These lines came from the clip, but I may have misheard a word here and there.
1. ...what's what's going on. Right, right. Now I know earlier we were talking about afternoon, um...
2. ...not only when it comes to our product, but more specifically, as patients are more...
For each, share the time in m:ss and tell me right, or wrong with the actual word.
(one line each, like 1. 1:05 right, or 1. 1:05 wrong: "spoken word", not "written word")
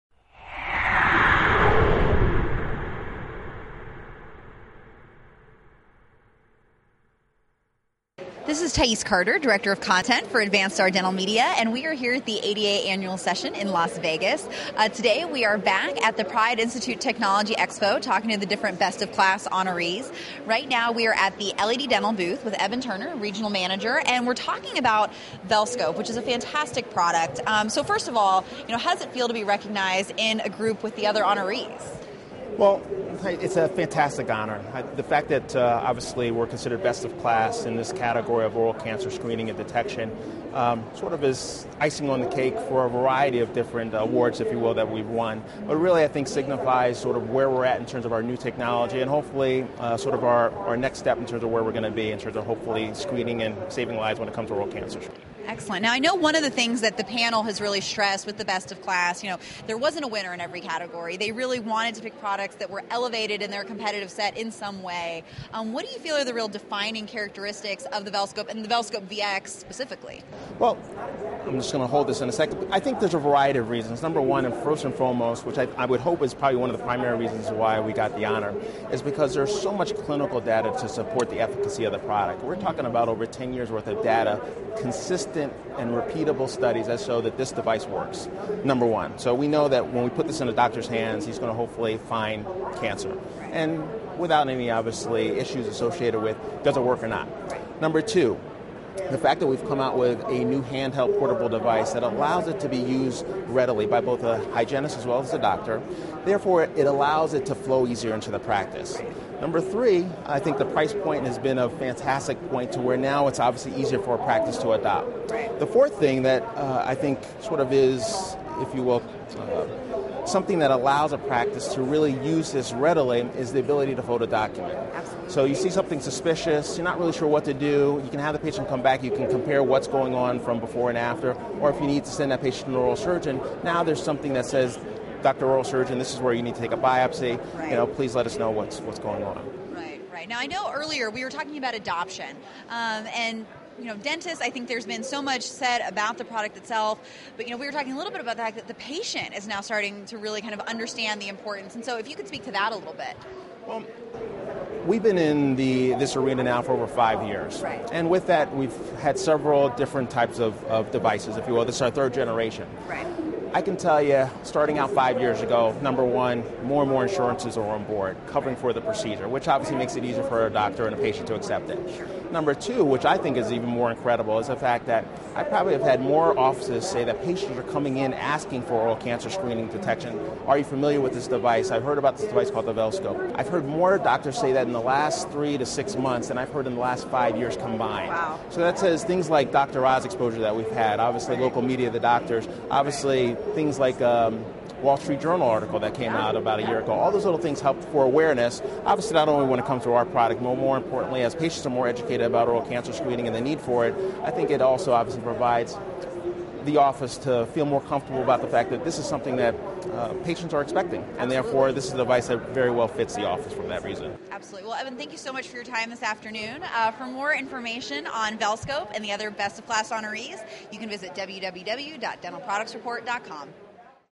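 1. 2:18 wrong: "adoption", not "afternoon"
2. 3:19 wrong: "importantly", not "specifically".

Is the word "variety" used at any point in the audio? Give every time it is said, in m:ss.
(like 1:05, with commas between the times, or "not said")
0:42, 1:13.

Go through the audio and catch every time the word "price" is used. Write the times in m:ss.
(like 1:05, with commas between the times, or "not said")
1:50.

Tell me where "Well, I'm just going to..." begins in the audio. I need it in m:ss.
1:10.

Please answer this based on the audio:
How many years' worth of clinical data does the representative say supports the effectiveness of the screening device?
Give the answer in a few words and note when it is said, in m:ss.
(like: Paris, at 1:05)
over 10 years, at 1:23.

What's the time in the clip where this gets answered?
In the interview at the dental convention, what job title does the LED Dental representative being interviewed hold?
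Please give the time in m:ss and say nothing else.
0:23.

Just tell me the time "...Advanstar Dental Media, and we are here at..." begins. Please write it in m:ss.
0:10.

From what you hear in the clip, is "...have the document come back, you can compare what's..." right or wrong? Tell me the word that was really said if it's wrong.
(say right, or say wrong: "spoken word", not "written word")
wrong: "patient", not "document".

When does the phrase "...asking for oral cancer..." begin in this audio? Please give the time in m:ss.
2:58.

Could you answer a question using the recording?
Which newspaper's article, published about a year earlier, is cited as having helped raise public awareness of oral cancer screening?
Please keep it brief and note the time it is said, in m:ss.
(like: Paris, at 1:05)
Wall Street Journal, at 3:14.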